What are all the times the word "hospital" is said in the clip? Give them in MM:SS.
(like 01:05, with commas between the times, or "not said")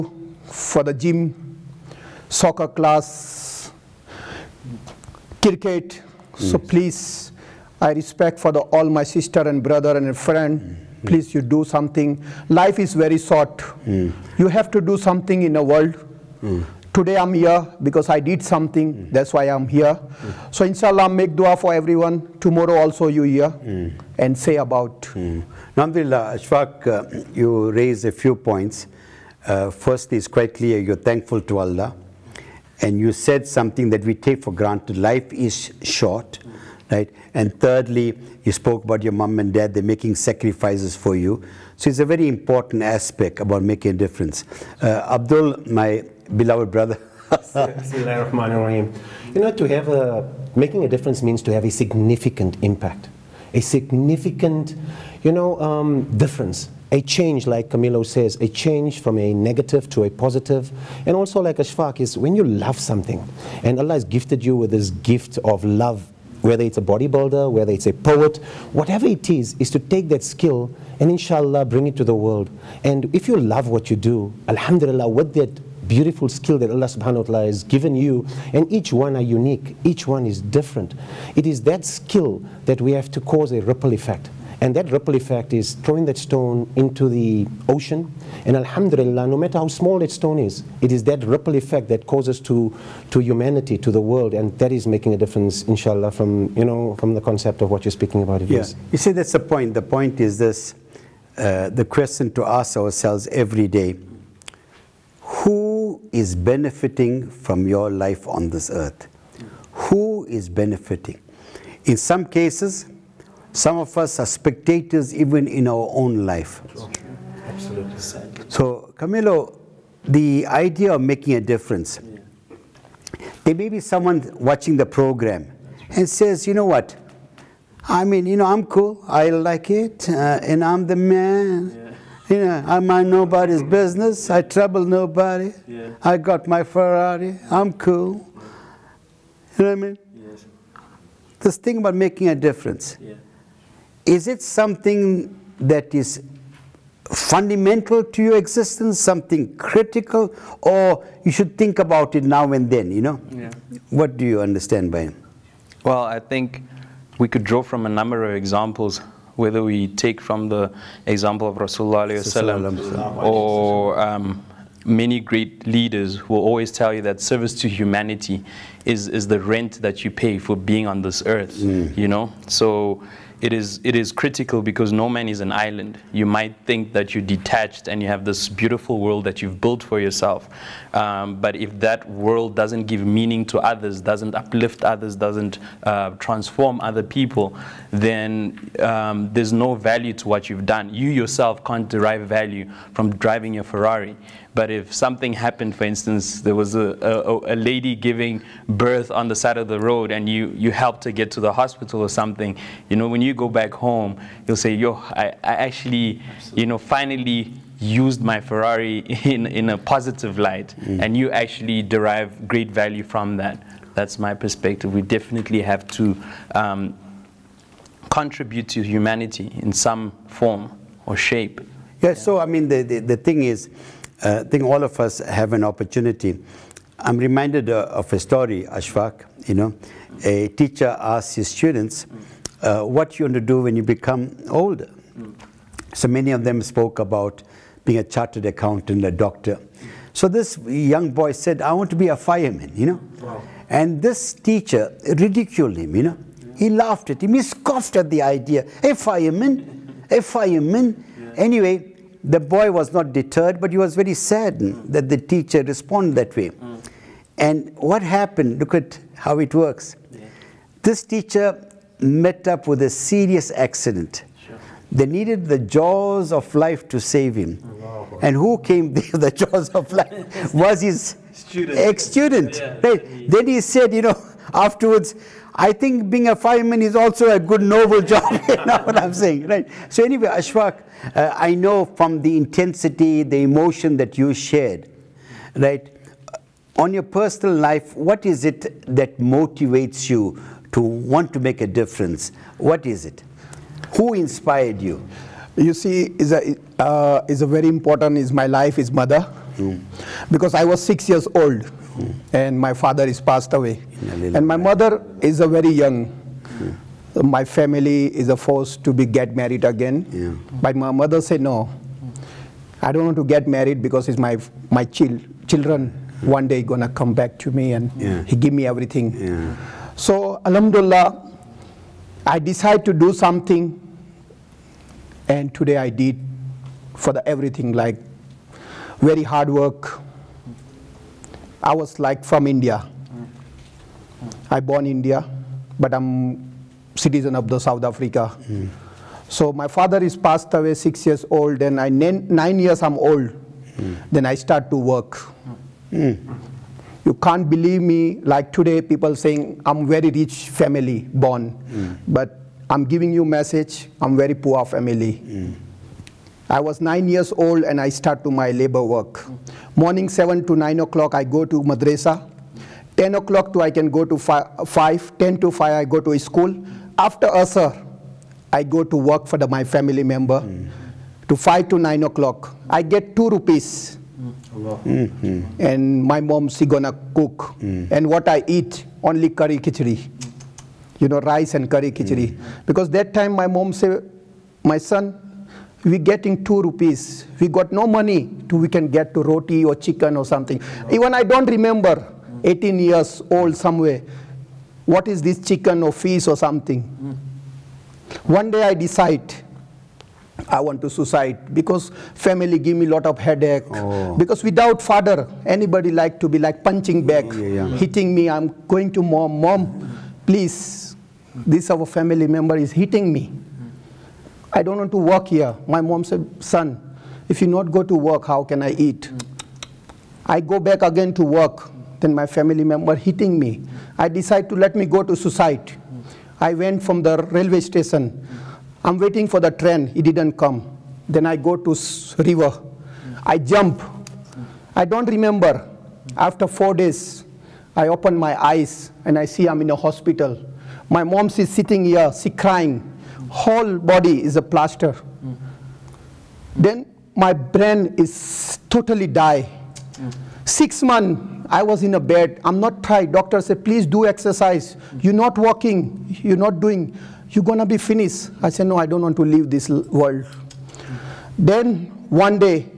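03:21, 07:19.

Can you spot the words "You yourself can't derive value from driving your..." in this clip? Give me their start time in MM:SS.
03:10.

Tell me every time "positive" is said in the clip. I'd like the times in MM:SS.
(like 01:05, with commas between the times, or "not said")
01:00, 03:29.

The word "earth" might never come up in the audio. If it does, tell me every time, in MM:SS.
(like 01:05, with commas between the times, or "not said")
01:48, 02:51.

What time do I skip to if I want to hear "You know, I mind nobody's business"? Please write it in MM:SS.
02:12.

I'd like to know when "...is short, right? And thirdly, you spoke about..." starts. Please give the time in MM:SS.
00:35.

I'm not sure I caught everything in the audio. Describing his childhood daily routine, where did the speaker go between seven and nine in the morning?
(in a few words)
Madrasa.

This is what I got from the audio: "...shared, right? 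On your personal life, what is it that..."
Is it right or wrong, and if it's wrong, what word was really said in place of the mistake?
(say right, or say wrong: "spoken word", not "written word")
right.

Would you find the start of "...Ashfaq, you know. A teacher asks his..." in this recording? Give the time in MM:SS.
03:48.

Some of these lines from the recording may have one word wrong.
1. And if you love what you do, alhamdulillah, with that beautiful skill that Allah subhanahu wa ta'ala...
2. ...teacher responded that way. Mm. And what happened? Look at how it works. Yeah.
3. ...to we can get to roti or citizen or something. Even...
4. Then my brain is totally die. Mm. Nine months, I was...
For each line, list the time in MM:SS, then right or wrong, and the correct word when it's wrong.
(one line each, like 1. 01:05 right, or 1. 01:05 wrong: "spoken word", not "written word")
1. 01:12 right
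2. 04:15 right
3. 06:28 wrong: "chicken", not "citizen"
4. 07:26 wrong: "Six", not "Nine".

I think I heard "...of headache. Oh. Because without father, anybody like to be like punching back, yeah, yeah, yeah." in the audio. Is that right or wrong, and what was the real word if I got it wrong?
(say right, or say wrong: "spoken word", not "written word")
right.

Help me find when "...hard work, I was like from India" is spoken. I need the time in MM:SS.
05:29.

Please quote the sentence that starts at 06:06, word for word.
After asar, I go to work for the, my family member.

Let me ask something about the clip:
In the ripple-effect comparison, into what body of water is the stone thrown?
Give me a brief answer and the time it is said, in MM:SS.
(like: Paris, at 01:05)
Ocean, at 01:27.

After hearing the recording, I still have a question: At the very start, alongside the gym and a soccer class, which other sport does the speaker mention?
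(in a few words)
Cricket.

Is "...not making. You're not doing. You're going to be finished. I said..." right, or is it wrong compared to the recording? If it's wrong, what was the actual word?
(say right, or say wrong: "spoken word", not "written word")
wrong: "walking", not "making".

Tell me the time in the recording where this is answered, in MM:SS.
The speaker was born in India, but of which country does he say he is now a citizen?
05:37.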